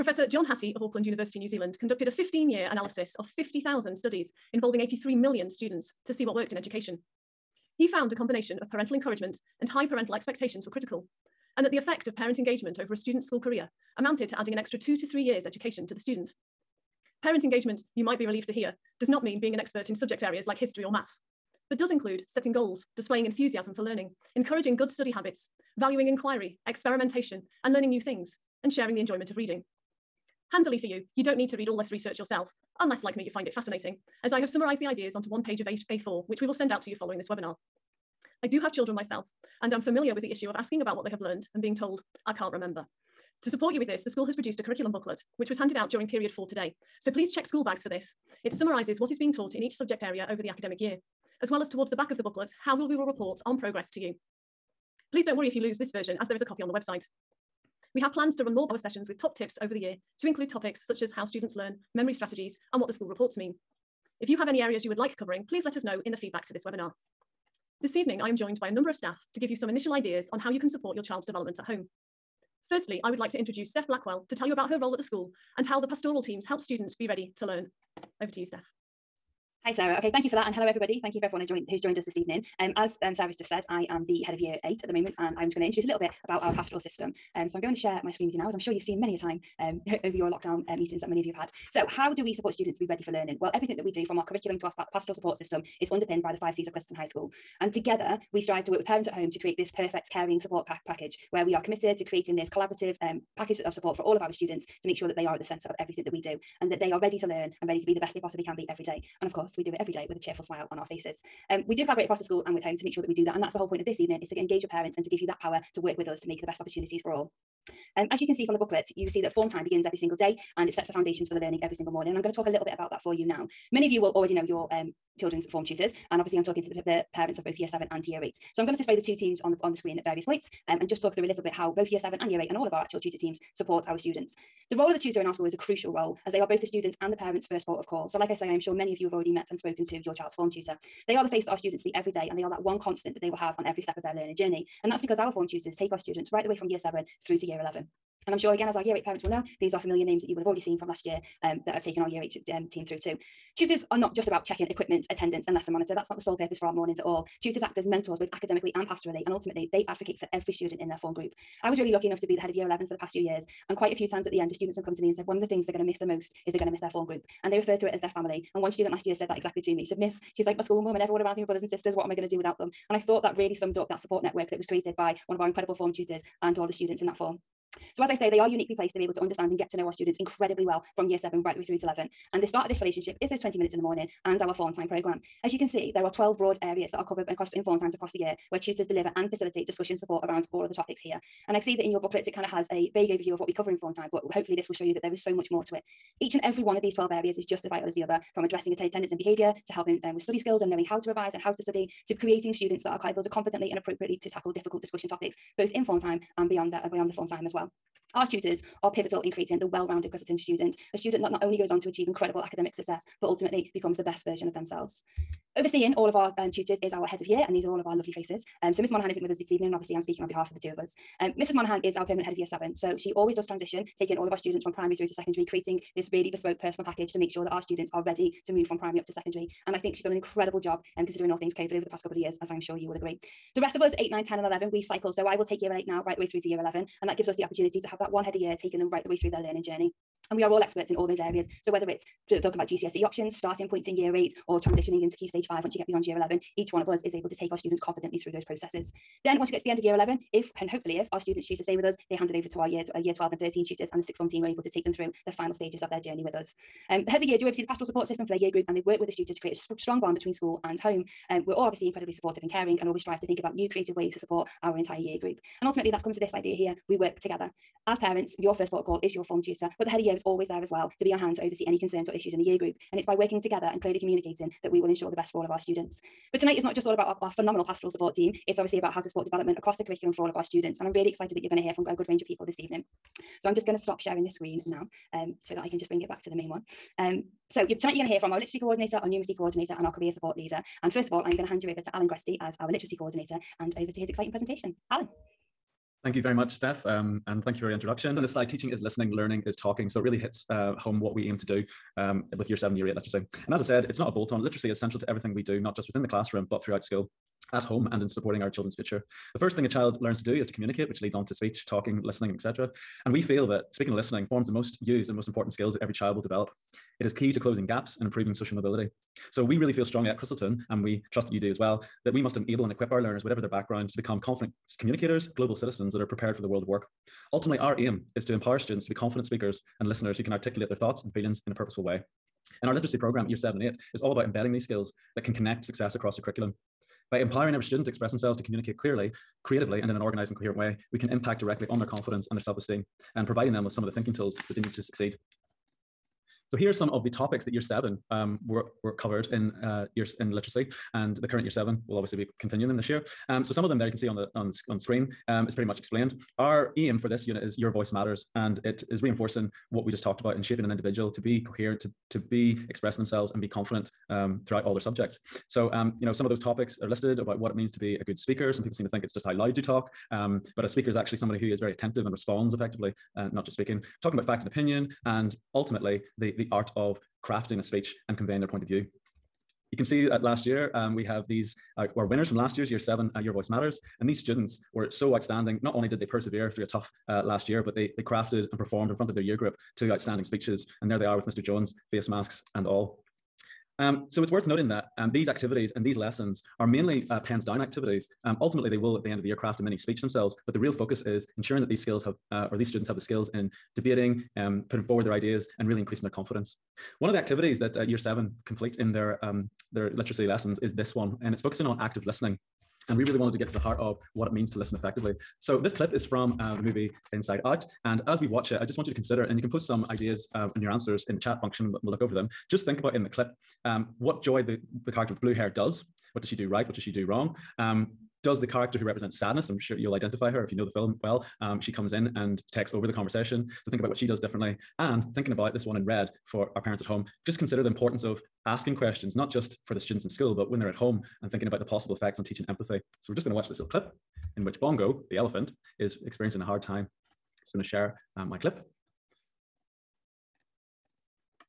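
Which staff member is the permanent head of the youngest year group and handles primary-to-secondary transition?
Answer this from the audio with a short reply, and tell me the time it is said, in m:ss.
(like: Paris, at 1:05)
Mrs. Monaghan, at 3:41.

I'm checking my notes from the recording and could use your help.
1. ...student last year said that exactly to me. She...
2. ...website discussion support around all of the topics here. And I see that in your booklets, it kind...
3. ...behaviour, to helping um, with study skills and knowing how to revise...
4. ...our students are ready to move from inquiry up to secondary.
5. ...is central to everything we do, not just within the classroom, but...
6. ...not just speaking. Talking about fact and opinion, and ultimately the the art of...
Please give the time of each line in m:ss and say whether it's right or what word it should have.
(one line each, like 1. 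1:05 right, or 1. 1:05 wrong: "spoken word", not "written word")
1. 2:48 right
2. 3:09 wrong: "facilitate", not "website"
3. 3:19 right
4. 3:47 wrong: "primary", not "inquiry"
5. 5:04 right
6. 6:13 right.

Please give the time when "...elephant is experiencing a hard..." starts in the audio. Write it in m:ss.
7:25.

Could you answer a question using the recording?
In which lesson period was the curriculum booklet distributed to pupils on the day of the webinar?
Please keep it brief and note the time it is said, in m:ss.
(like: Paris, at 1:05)
period 4, at 0:46.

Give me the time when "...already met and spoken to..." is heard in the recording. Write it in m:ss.
2:19.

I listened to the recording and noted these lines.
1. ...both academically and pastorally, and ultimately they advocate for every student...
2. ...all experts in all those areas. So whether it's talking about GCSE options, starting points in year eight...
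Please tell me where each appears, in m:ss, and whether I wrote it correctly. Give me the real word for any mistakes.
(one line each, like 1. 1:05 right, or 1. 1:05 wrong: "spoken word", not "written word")
1. 2:38 right
2. 4:00 right.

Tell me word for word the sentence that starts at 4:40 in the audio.
And I'm really excited that you're going to hear from a good range of people this evening.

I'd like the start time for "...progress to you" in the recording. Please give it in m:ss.
0:53.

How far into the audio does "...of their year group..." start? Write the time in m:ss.
6:29.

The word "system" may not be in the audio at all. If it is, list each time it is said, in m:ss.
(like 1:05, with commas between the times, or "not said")
1:26, 1:35, 4:18.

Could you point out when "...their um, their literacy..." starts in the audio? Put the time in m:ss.
6:48.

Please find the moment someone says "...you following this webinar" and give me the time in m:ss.
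0:36.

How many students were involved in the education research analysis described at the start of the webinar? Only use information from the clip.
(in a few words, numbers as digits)
83 million.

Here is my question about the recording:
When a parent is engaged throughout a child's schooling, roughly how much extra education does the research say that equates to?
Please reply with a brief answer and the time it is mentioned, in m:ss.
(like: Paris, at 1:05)
2 to 3 years, at 0:14.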